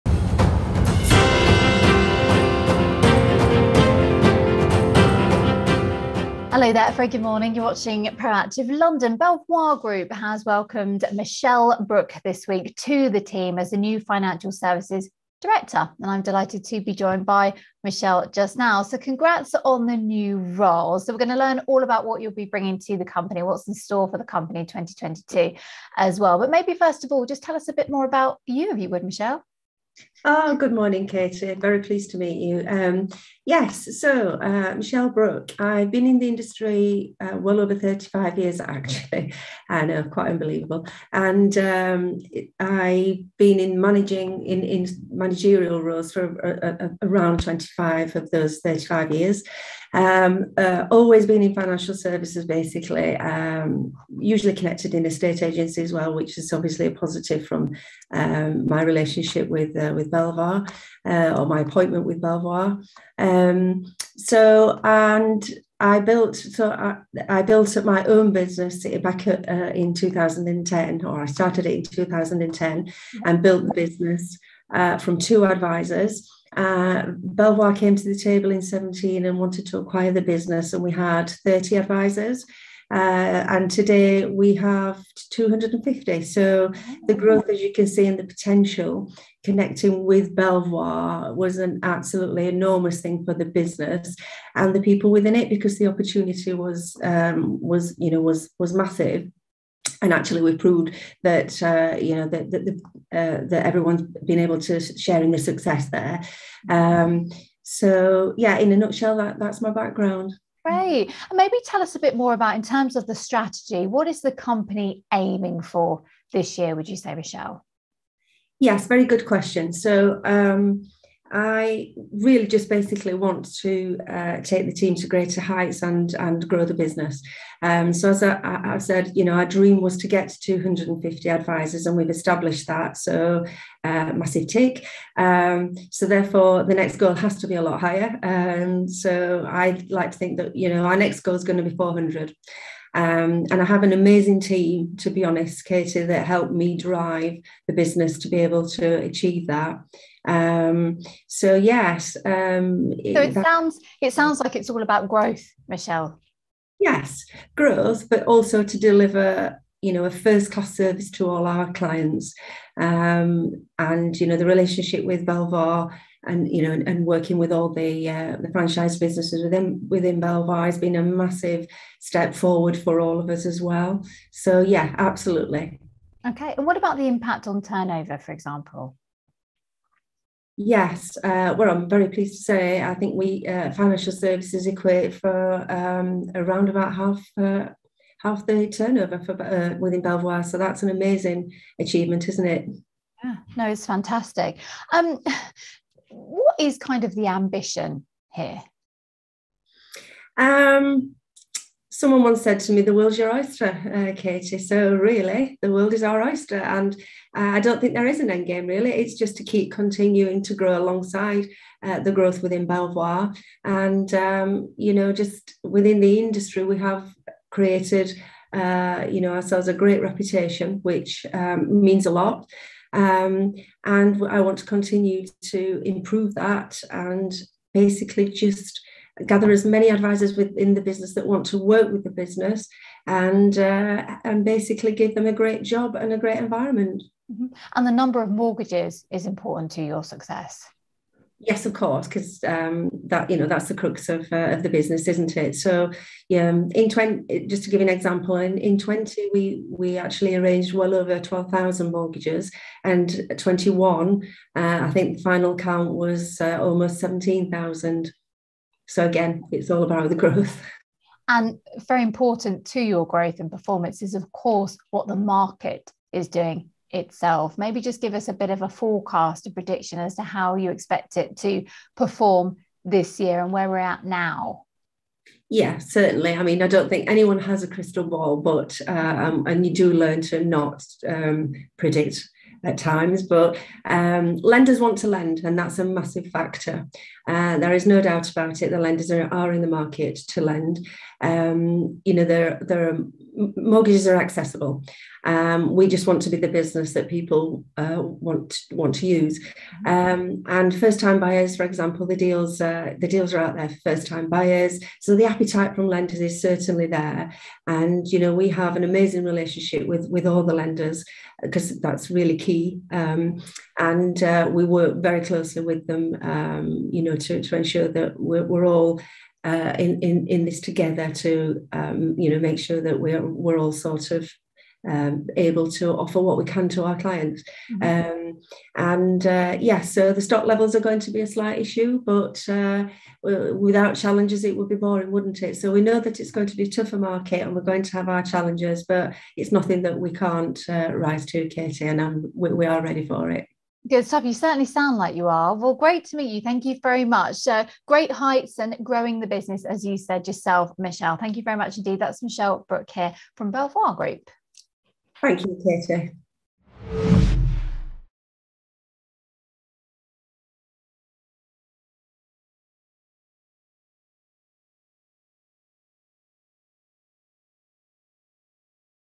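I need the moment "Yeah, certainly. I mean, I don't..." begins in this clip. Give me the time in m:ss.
4:35.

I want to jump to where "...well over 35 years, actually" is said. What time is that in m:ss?
0:37.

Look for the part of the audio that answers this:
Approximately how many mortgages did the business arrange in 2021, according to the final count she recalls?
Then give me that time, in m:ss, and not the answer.
4:16.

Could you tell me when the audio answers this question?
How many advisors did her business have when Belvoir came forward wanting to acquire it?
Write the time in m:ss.
1:20.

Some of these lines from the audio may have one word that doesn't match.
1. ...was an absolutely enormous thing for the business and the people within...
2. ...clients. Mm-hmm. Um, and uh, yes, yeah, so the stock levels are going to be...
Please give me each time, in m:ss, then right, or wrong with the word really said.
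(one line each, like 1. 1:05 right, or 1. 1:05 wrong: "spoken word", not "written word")
1. 1:31 right
2. 5:26 right.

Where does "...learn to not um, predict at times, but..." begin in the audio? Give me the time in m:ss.
4:39.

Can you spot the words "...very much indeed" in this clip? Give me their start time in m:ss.
5:51.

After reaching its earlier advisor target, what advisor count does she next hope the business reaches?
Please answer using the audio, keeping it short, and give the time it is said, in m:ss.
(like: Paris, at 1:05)
400, at 2:20.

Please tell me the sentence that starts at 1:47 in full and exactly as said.
um, so yeah in a nutshell that that's my background Great.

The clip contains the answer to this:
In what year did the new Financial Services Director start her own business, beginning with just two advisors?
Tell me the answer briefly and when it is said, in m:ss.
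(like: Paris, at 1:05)
2010, at 1:11.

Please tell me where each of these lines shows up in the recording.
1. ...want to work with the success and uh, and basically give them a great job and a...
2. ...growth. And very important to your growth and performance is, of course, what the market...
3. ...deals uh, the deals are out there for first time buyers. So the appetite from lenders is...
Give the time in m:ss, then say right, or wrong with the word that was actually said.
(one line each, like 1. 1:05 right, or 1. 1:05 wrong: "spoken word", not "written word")
1. 3:51 wrong: "business", not "success"
2. 4:20 right
3. 5:02 right.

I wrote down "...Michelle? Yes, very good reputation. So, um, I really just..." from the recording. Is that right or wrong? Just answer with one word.
wrong.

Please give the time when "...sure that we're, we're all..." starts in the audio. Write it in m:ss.
5:22.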